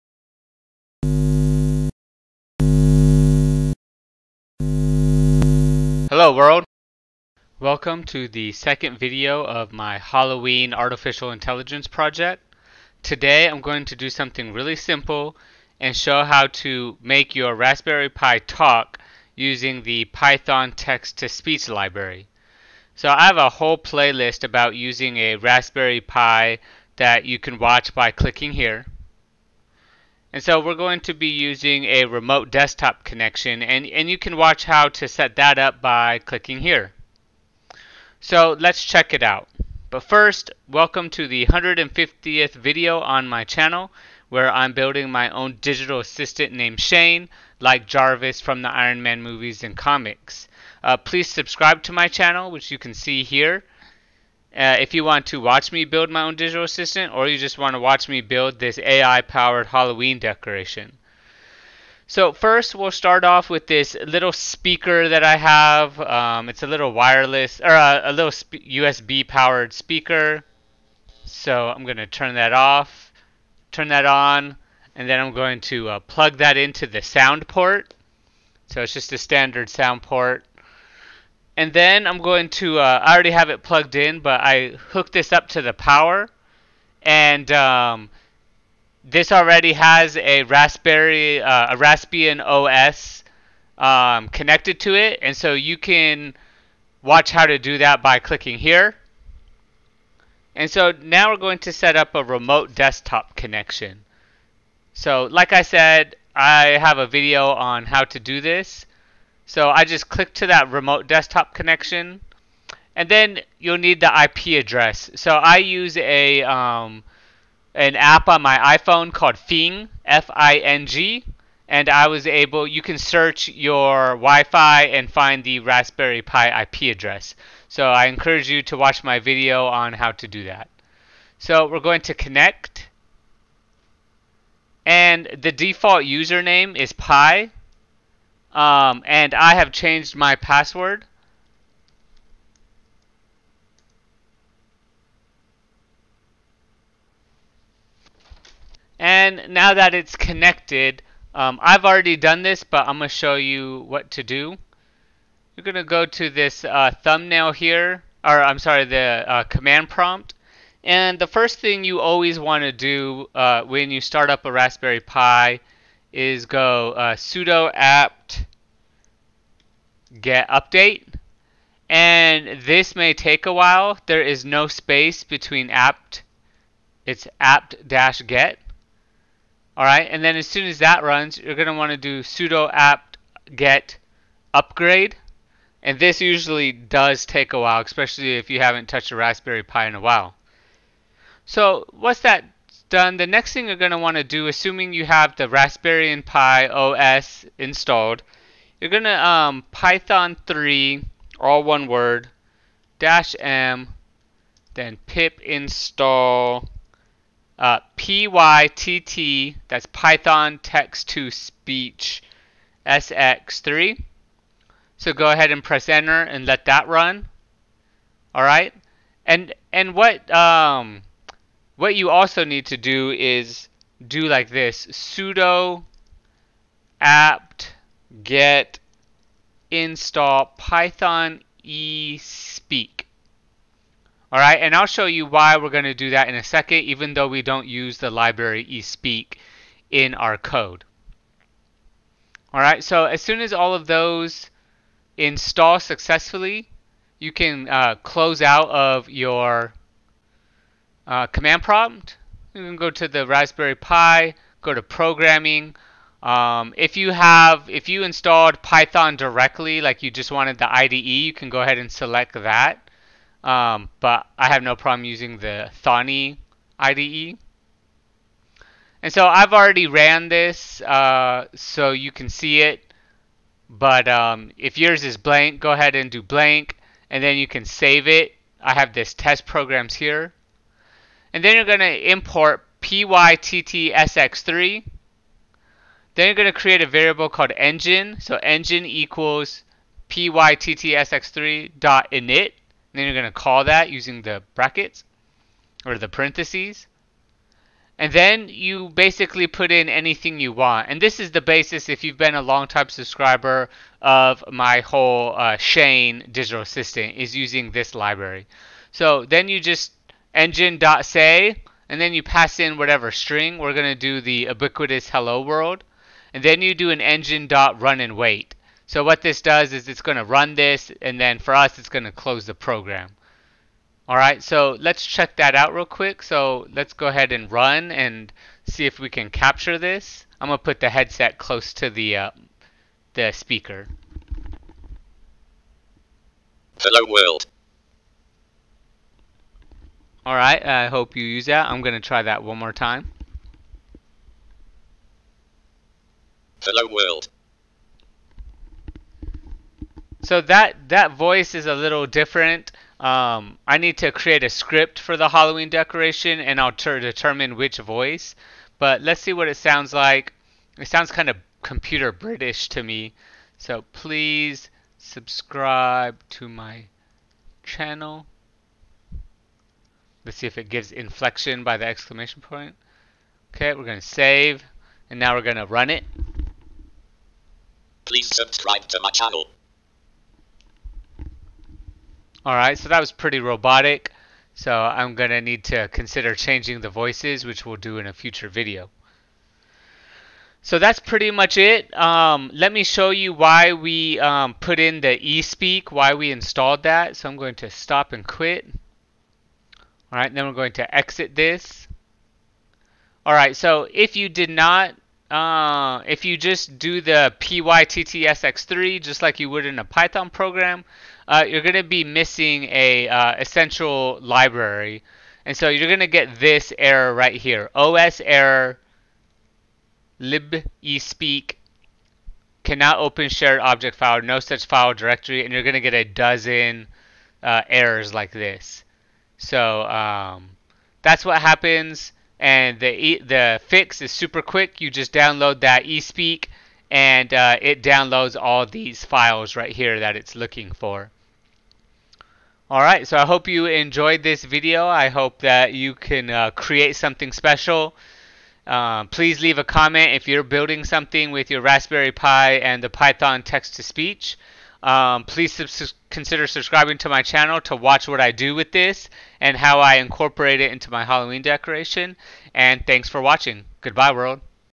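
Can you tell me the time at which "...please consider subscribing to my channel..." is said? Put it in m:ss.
7:35.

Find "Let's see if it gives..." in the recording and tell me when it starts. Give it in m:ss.
6:10.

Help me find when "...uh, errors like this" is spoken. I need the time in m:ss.
7:07.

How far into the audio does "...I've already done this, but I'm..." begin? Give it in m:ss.
2:31.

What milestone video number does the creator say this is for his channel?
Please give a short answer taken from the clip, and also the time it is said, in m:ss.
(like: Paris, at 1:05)
150th, at 0:41.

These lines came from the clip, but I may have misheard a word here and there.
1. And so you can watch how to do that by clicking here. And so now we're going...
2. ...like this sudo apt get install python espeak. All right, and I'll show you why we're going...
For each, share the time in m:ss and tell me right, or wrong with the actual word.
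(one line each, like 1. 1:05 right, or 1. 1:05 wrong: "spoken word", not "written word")
1. 1:35 right
2. 3:44 right.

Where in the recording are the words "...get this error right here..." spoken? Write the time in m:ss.
6:56.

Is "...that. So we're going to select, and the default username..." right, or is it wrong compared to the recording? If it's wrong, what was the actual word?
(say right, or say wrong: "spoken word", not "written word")
wrong: "connect", not "select".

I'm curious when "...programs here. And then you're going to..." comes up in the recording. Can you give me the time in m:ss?
4:39.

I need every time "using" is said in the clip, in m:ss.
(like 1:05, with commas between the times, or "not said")
0:19, 0:24, 0:31, 4:25, 4:53, 5:07.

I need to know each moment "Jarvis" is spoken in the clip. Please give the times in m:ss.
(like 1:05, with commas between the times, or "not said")
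0:47.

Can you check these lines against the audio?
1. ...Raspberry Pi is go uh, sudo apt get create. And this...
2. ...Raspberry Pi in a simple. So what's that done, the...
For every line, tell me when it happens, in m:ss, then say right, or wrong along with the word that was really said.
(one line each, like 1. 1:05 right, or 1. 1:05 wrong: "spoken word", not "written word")
1. 2:44 wrong: "update", not "create"
2. 3:09 wrong: "while", not "simple".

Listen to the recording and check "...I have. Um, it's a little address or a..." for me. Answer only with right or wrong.
wrong.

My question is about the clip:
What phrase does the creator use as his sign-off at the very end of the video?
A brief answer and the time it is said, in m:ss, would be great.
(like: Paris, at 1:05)
Goodbye, world, at 7:43.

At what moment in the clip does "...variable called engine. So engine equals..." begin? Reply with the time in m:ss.
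4:46.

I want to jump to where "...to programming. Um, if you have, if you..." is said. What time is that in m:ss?
4:14.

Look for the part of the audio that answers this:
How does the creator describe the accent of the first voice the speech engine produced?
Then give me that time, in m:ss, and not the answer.
6:01.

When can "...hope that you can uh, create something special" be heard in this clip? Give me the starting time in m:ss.
7:25.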